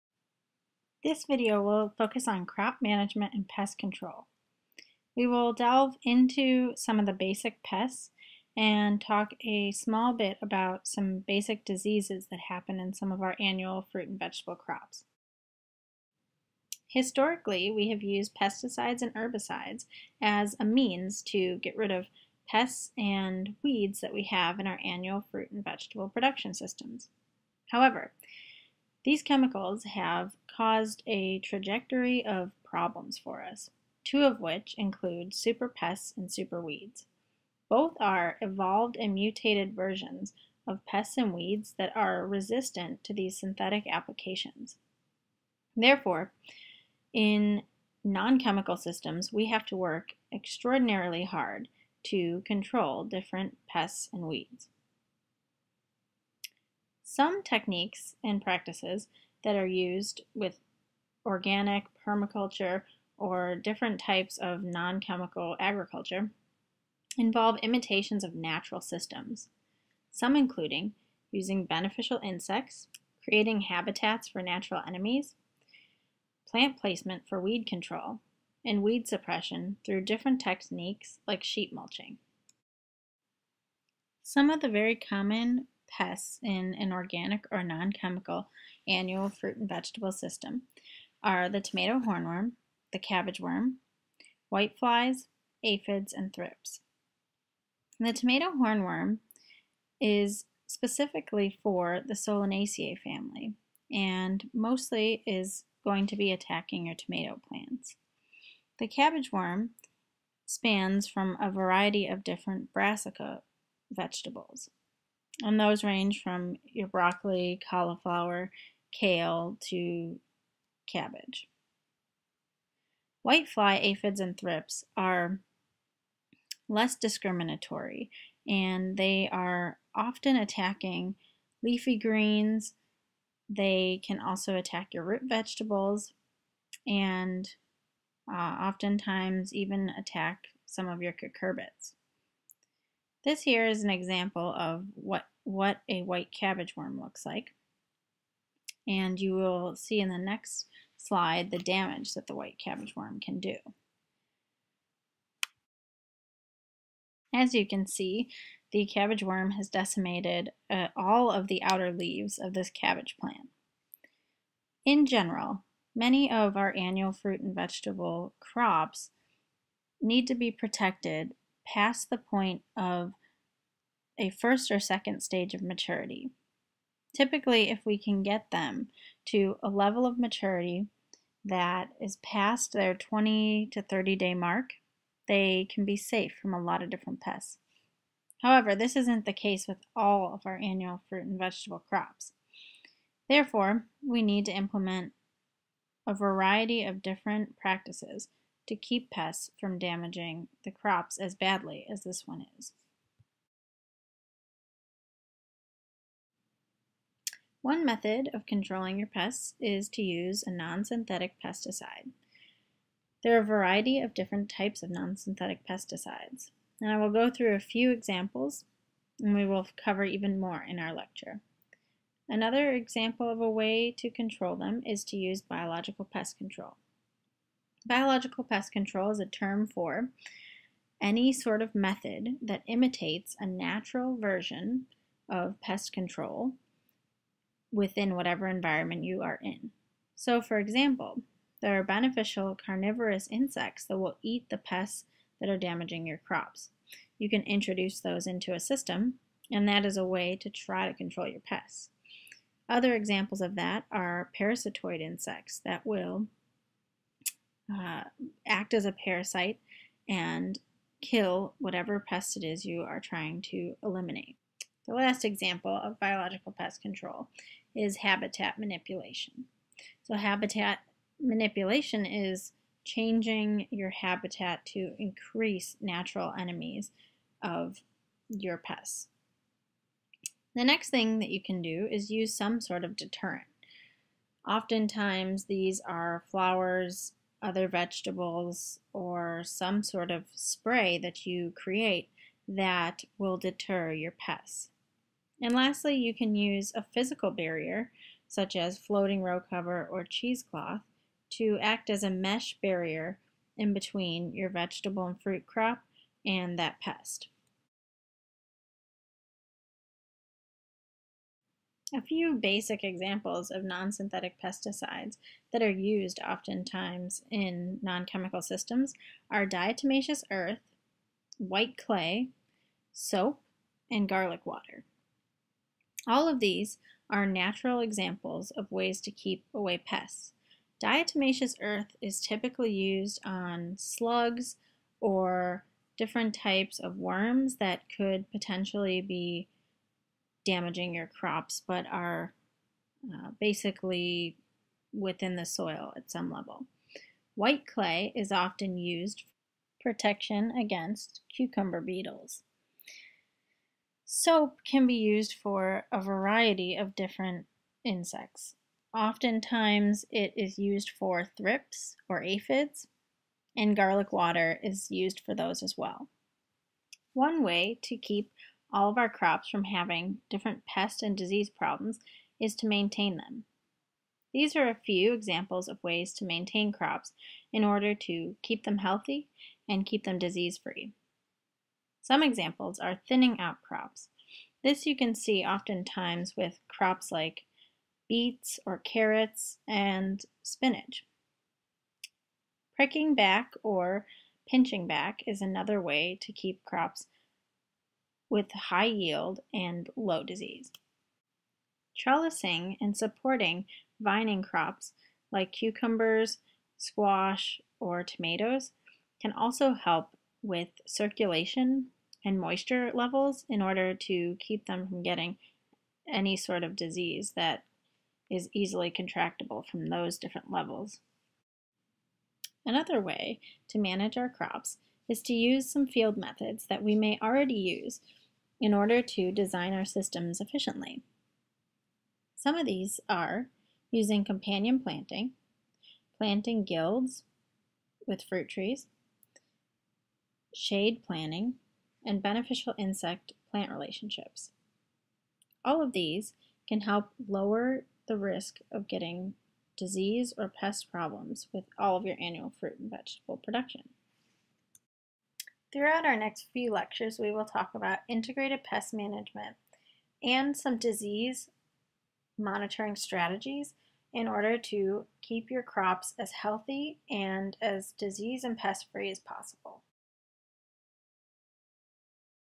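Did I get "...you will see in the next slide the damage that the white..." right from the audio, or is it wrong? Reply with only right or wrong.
right.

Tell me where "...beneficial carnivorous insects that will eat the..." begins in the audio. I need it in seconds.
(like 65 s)
241 s.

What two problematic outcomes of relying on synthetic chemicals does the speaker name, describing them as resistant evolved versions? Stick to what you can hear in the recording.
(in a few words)
super pests and super weeds.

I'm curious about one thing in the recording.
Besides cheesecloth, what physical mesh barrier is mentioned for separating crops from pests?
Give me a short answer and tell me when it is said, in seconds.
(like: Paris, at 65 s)
floating row cover, at 298 s.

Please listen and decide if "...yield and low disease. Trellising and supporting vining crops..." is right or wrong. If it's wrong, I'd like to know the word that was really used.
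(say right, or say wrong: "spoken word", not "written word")
right.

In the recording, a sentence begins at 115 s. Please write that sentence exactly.
And those range from your broccoli, cauliflower, kale to cabbage.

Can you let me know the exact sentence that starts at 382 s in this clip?
Some examples are thinning out crops.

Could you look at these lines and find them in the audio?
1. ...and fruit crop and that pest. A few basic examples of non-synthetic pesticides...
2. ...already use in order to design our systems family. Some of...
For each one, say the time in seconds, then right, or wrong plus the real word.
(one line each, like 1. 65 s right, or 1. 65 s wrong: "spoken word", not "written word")
1. 305 s right
2. 427 s wrong: "efficiently", not "family".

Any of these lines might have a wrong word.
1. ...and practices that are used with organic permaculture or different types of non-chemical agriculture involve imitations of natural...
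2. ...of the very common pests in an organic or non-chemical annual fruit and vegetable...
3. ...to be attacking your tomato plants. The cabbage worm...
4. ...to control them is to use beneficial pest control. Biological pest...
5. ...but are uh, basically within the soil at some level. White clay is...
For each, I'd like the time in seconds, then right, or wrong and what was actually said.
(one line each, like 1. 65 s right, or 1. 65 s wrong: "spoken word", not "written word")
1. 58 s right
2. 84 s right
3. 106 s right
4. 223 s wrong: "biological", not "beneficial"
5. 341 s right.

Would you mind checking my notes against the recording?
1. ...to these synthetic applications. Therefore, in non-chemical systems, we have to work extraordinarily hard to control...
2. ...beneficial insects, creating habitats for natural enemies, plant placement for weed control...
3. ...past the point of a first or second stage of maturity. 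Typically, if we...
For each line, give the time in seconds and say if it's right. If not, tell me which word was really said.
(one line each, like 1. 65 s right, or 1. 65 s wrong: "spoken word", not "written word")
1. 43 s right
2. 71 s right
3. 171 s right.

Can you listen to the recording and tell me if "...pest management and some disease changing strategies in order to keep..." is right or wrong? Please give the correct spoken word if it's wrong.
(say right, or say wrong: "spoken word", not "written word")
wrong: "monitoring", not "changing".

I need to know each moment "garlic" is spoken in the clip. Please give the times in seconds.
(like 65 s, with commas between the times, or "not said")
324 s, 363 s.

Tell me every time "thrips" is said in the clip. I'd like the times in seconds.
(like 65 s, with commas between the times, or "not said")
96 s, 124 s, 361 s.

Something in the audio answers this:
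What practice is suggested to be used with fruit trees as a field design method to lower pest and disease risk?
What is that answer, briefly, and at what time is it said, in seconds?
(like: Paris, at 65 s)
planting guilds, at 436 s.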